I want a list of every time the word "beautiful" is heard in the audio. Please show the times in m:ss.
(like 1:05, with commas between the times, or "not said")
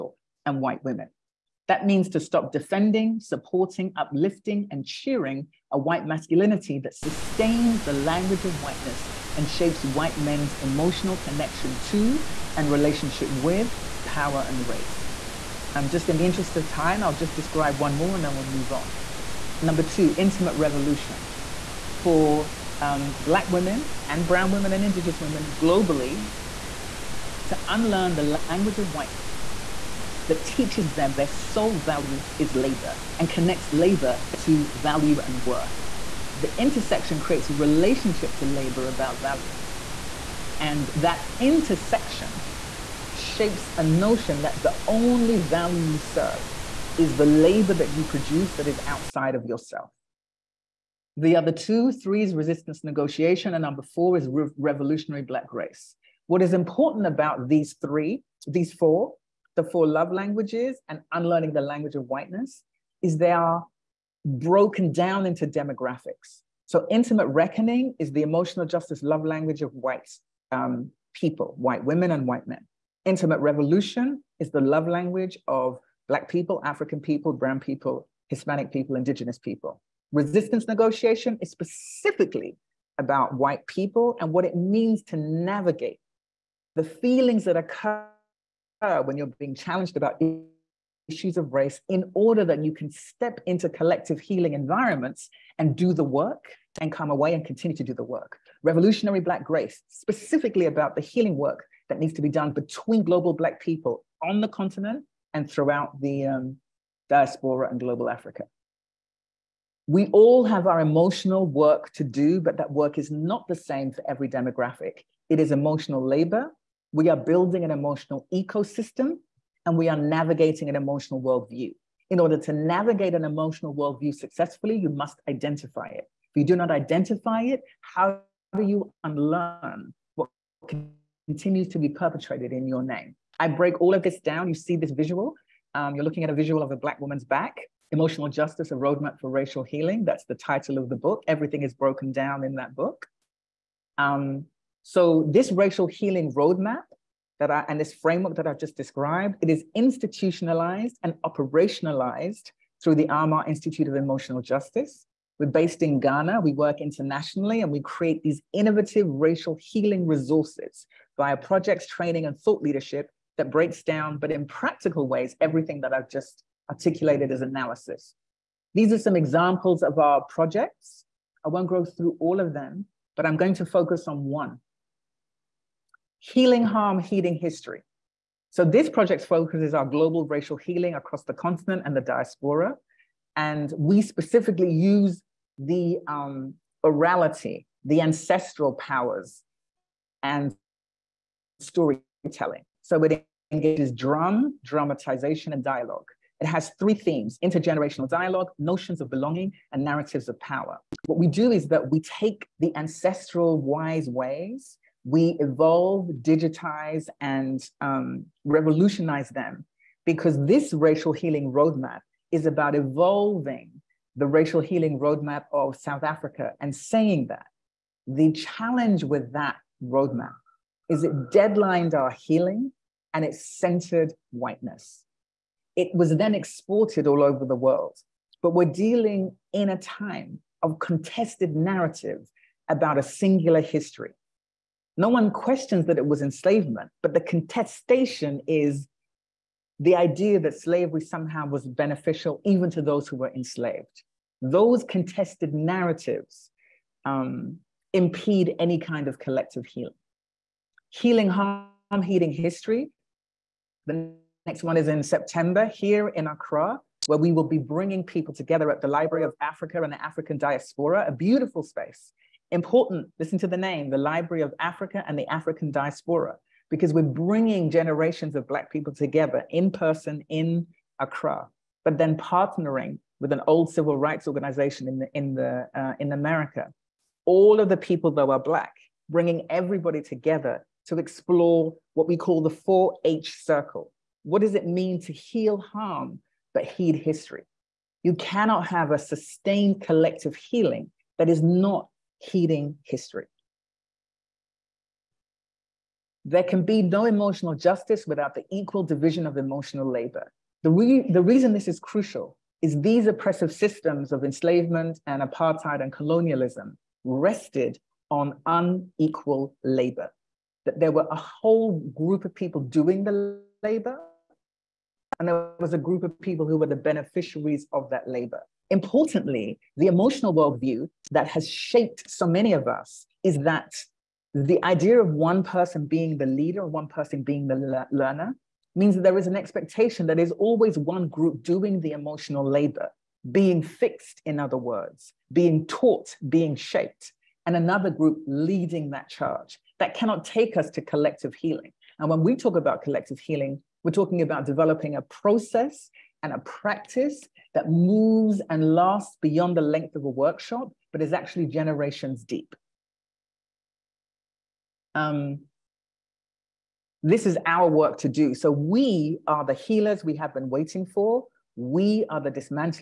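4:21.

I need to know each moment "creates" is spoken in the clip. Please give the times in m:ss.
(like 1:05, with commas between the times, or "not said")
0:37, 2:37.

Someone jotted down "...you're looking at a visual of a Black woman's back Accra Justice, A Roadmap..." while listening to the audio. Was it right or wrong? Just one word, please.
wrong.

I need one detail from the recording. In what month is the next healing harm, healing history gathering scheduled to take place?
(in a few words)
September.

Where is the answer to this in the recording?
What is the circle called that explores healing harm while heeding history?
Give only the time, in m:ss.
4:42.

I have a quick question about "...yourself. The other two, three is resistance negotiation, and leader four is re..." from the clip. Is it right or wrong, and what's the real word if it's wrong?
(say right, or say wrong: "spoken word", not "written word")
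wrong: "number", not "leader".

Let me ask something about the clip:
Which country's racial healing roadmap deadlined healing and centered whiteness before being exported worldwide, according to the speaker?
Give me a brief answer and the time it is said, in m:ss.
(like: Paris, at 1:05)
South Africa, at 3:35.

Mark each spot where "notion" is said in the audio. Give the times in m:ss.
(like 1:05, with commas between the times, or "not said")
0:43, 3:18.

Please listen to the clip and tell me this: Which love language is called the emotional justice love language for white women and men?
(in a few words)
Intimate reckoning.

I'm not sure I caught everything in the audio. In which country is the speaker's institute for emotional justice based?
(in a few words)
Ghana.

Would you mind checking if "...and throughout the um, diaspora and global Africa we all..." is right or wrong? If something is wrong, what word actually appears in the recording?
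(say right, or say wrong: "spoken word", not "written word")
right.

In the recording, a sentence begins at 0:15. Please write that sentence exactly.
Um, just in the interest of time, I'll just describe one more and then we'll move on.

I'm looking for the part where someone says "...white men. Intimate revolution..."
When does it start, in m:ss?
1:12.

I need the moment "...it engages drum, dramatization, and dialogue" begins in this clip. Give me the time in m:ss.
3:13.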